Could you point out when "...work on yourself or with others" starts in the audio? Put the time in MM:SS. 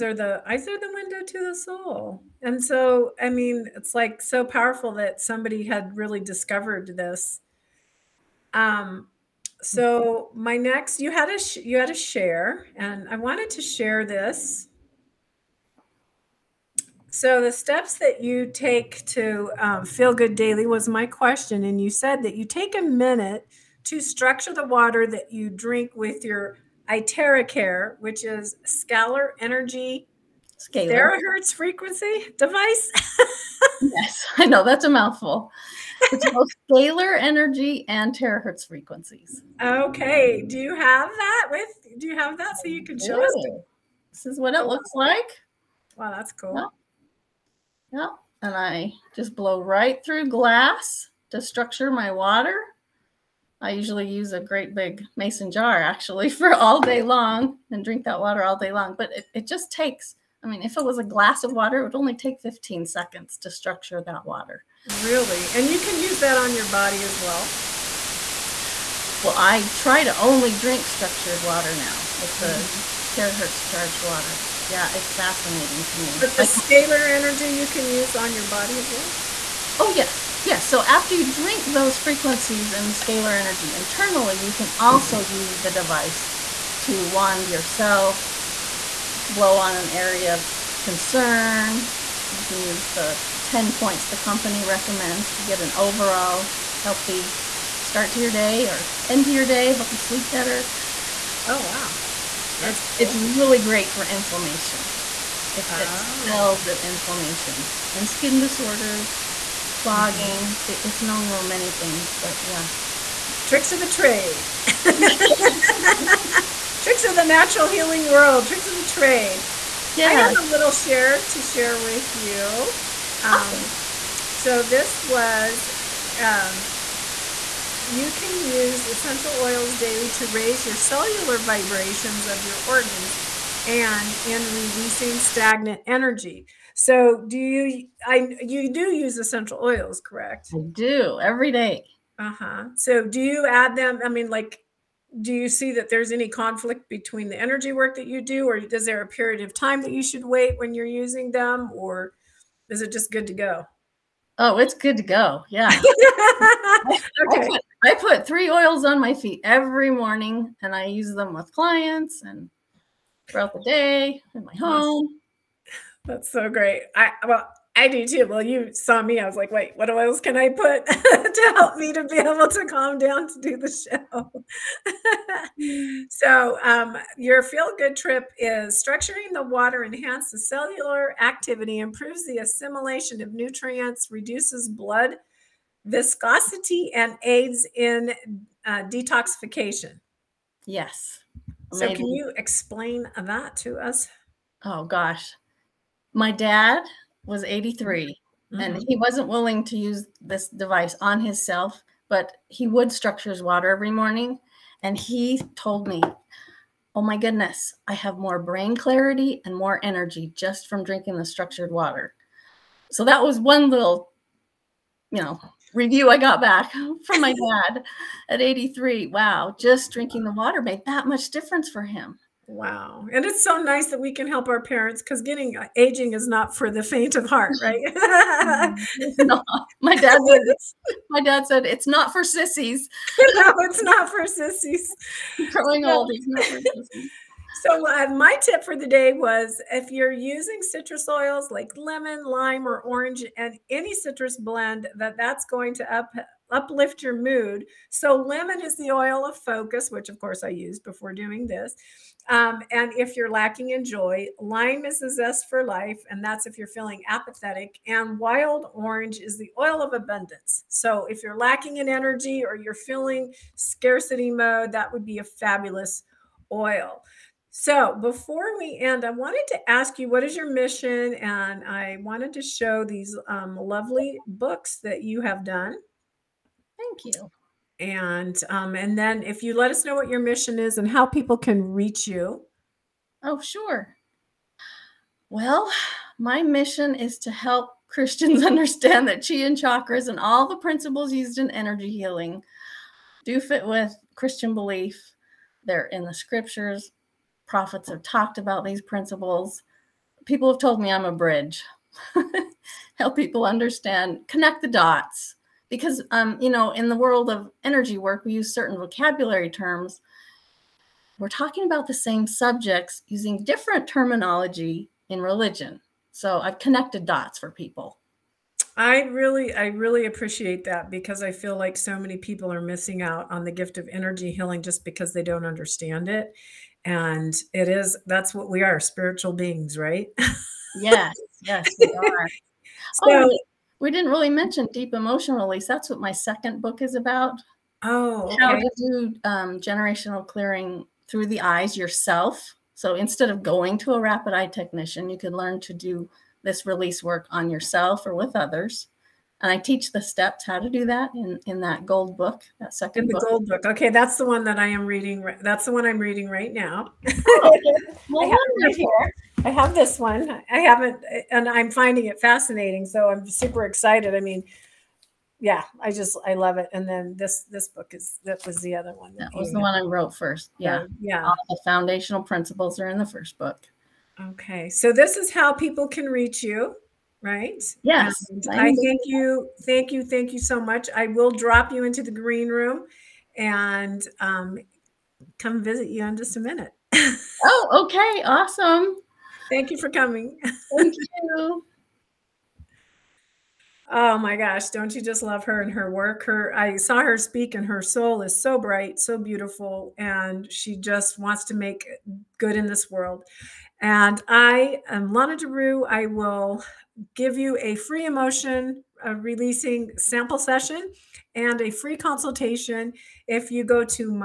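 05:47.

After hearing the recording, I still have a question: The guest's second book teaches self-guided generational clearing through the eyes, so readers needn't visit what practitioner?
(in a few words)
Rapid eye technician.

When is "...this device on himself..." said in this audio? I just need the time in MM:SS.
03:20.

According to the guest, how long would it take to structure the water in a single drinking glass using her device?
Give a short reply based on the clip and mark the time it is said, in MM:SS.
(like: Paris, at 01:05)
15 seconds, at 01:02.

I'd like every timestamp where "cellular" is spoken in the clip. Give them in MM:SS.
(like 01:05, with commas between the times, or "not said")
02:10, 03:00.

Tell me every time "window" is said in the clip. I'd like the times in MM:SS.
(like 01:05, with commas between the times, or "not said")
00:00.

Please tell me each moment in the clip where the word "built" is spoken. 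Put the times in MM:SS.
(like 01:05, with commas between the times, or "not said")
not said.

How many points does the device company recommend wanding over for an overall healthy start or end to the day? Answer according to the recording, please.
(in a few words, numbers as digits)
10.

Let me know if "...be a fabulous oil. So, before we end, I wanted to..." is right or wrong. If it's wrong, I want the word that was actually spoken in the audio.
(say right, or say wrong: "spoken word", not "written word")
right.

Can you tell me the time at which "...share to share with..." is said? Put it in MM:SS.
02:00.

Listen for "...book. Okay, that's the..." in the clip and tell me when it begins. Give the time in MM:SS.
05:53.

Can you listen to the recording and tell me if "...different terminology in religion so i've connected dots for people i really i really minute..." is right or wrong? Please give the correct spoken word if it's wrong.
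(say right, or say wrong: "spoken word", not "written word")
wrong: "appreciate", not "minute".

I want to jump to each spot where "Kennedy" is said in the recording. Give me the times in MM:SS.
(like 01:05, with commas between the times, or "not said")
not said.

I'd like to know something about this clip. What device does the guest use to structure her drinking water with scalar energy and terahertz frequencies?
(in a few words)
Iteracare.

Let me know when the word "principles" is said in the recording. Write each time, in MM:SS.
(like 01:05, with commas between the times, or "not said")
04:50, 04:58, 06:12.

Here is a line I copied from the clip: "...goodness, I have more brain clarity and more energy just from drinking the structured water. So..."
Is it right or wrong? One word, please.
right.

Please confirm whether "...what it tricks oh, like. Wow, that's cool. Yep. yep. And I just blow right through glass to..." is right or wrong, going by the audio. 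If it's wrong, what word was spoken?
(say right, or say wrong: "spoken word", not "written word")
wrong: "looks", not "tricks".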